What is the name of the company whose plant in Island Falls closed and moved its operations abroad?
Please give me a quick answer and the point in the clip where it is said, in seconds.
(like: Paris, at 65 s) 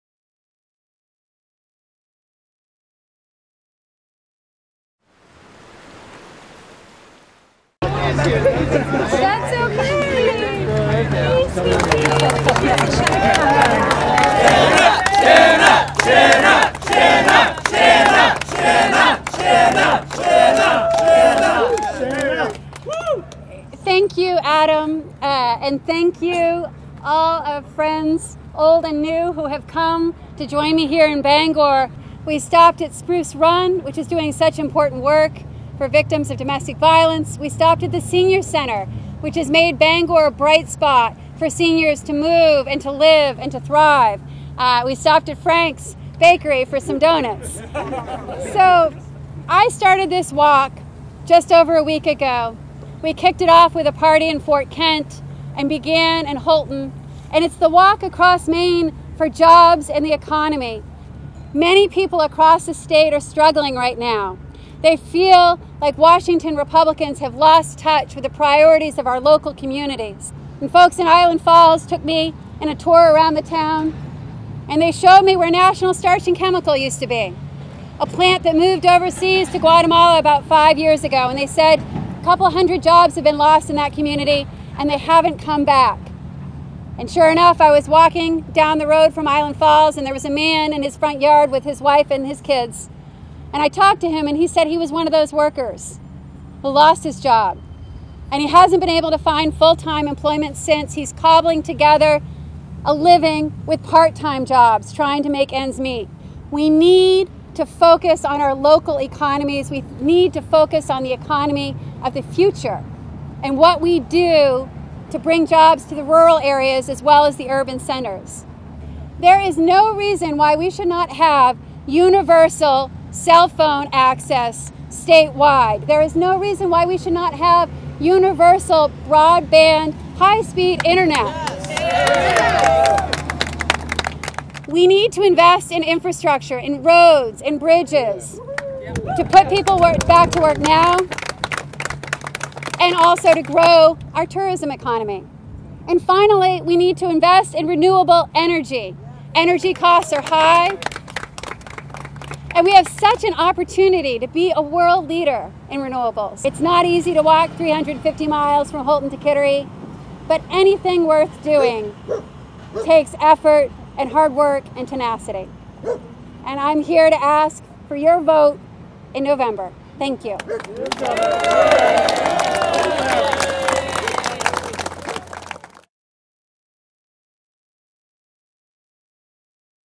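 National Starch and Chemical, at 75 s.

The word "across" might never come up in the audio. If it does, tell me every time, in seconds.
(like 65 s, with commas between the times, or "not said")
58 s, 62 s.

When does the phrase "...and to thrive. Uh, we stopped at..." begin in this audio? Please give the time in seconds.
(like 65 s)
43 s.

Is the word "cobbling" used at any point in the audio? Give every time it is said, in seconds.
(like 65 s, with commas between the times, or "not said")
101 s.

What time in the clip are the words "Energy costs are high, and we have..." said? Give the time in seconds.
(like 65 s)
149 s.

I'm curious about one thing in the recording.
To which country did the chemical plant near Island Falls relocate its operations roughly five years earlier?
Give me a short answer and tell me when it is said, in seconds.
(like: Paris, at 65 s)
Guatemala, at 79 s.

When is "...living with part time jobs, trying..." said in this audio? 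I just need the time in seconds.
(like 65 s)
102 s.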